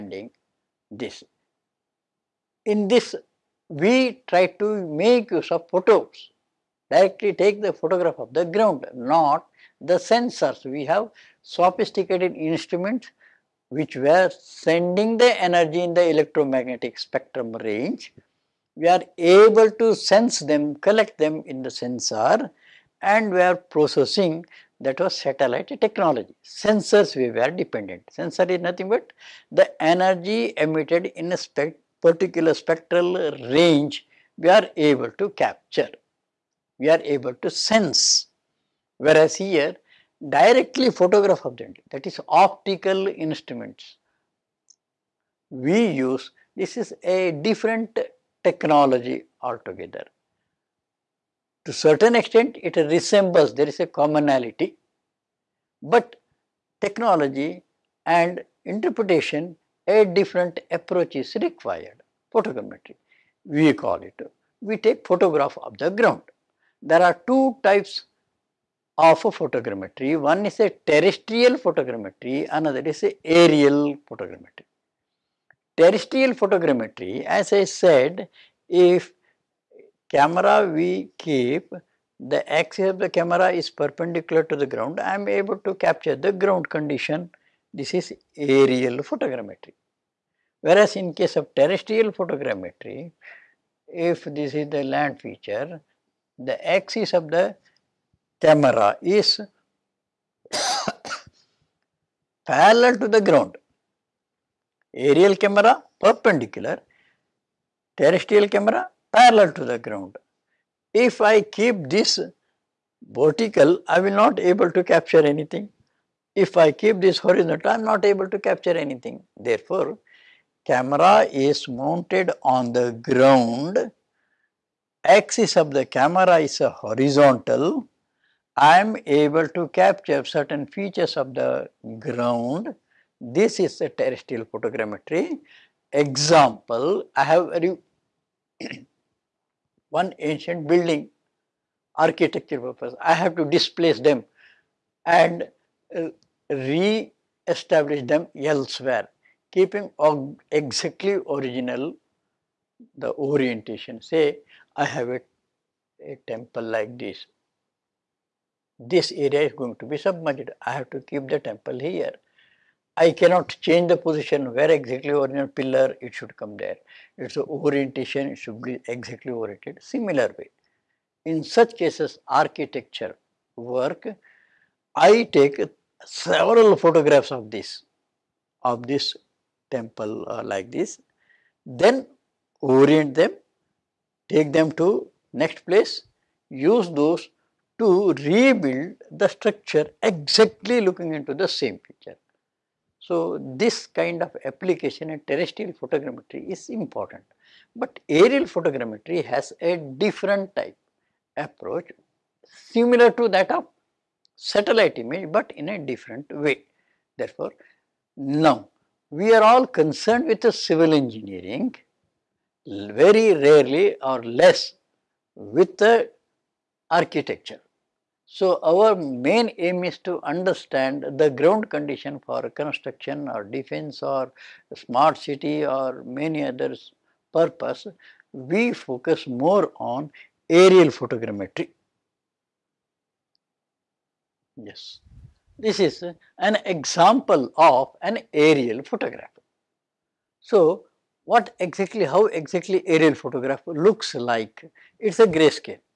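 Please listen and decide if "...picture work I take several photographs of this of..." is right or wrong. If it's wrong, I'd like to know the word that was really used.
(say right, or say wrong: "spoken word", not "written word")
wrong: "architecture", not "picture".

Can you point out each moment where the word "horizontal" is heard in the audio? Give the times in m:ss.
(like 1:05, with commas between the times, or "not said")
1:57, 2:06.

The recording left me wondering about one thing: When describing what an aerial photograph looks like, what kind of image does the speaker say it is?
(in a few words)
Grayscale.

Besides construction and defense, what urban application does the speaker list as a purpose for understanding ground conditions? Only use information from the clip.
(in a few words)
Smart city.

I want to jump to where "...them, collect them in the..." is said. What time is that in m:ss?
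0:20.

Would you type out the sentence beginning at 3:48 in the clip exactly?
We focus more on aerial photogrammetry.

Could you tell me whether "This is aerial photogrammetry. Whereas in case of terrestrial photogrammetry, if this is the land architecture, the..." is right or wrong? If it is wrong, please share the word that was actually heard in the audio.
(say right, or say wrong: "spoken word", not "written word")
wrong: "feature", not "architecture".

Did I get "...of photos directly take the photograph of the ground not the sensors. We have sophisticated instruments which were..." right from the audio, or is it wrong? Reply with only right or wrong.
right.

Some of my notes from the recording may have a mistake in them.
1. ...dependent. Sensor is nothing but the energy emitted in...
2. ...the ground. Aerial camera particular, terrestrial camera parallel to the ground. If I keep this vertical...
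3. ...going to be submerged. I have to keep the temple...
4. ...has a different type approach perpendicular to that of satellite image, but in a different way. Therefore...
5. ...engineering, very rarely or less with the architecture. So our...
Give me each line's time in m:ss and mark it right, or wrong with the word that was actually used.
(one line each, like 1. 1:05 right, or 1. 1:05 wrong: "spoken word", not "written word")
1. 0:27 right
2. 1:43 wrong: "perpendicular", not "particular"
3. 2:39 right
4. 3:19 wrong: "similar", not "perpendicular"
5. 3:30 right.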